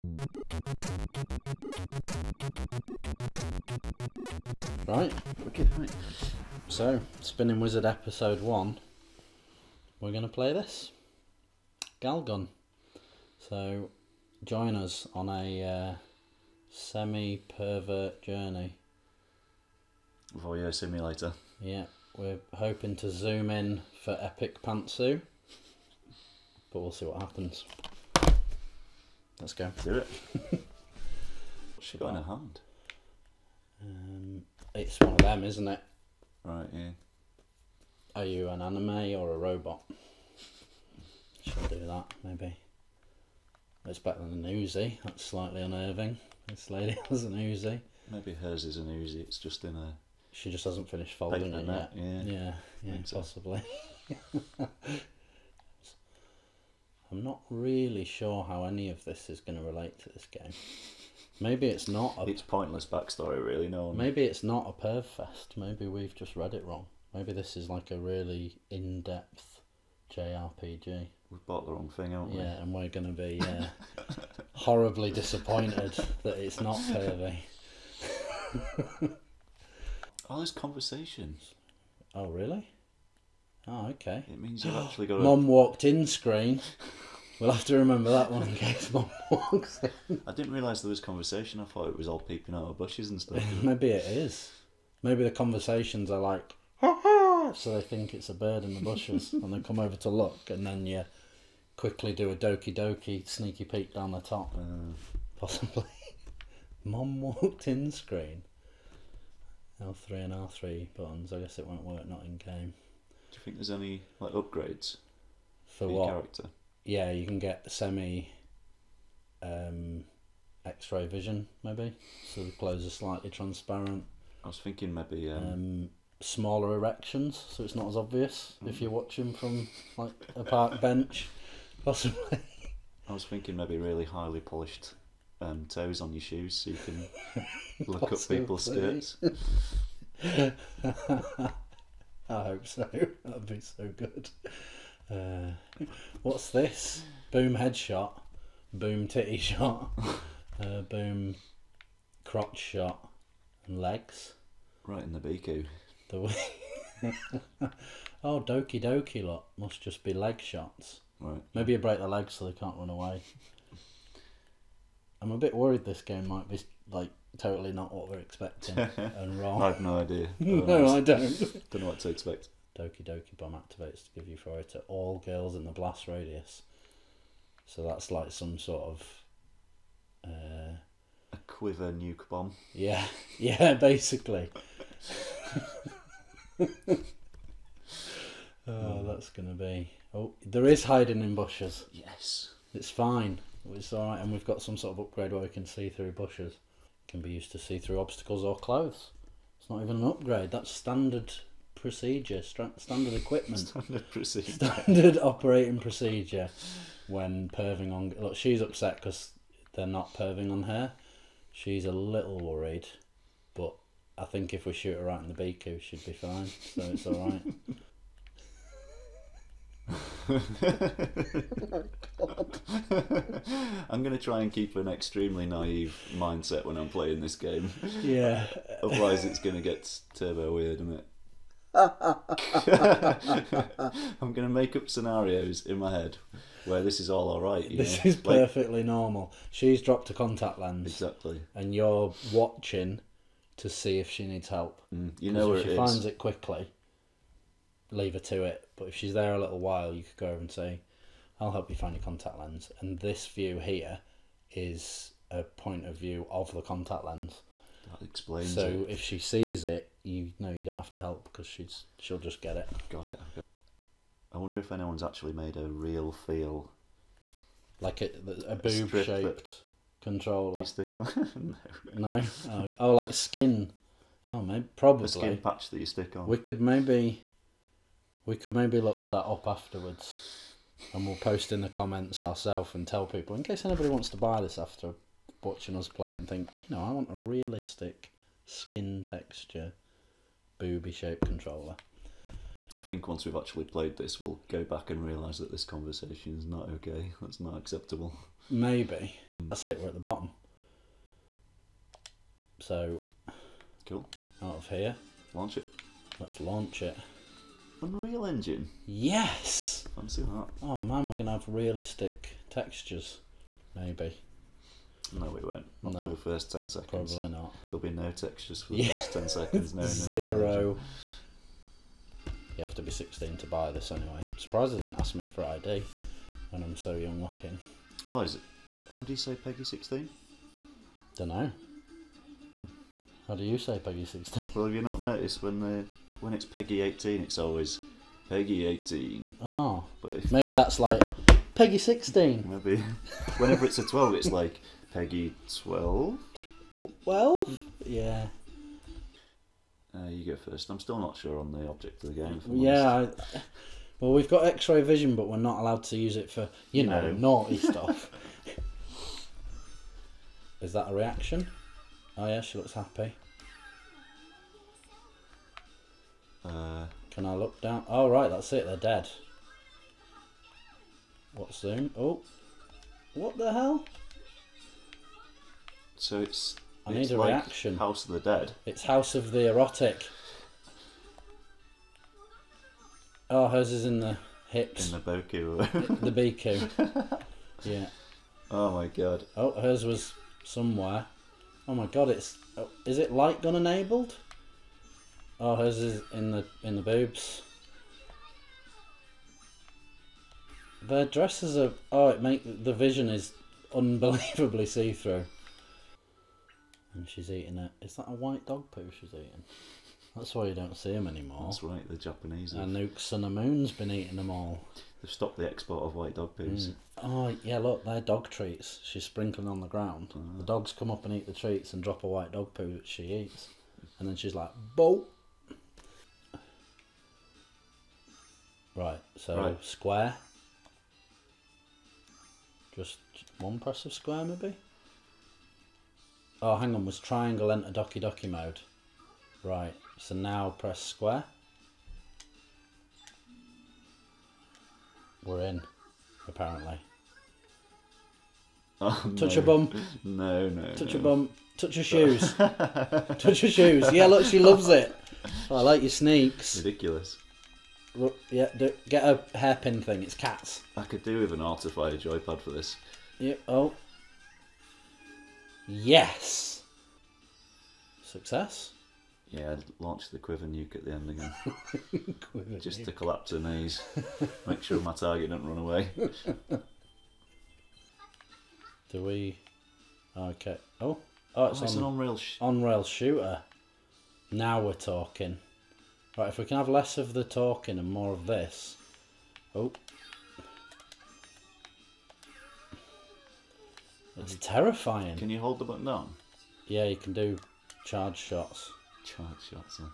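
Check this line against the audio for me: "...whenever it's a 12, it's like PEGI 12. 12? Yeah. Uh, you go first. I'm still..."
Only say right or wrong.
right.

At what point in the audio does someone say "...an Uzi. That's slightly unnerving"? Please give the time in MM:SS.
00:44.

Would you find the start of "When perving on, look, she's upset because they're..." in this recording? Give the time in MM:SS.
03:27.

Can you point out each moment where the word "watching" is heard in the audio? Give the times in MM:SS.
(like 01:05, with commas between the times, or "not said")
02:08, 04:02, 04:45.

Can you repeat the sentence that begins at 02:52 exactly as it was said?
Doki Doki Bomb activates to give you four to all girls in the blast radius.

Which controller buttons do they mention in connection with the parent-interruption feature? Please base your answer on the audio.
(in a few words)
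L3 and R3.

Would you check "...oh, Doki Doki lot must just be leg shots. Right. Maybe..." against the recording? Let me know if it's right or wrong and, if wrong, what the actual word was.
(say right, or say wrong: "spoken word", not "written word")
right.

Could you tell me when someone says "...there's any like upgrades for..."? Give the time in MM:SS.
01:53.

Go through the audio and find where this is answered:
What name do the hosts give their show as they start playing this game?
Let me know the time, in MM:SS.
00:07.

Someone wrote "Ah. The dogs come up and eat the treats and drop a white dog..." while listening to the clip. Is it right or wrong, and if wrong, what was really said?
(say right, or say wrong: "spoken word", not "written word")
right.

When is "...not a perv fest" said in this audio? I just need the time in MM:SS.
01:04.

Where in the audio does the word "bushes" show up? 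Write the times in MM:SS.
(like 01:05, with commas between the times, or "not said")
01:32, 01:38, 03:11, 03:16.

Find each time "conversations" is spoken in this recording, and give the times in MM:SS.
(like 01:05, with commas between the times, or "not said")
01:20, 01:30, 01:35, 04:55.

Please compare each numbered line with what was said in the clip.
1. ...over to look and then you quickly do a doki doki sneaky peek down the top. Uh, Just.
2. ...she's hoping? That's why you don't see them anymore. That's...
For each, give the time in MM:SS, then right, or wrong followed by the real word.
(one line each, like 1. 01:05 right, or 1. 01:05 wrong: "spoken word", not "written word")
1. 01:39 wrong: "Possibly", not "Just"
2. 06:48 wrong: "eating", not "hoping".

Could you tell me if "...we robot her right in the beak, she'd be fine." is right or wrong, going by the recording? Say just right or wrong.
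wrong.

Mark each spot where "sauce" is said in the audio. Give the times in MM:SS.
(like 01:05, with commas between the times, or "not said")
not said.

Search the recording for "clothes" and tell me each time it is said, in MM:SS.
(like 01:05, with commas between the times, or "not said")
02:02, 03:18.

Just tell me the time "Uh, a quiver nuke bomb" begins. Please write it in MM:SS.
03:00.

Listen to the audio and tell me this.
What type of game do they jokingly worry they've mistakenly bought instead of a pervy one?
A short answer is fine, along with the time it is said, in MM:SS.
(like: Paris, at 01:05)
JRPG, at 01:10.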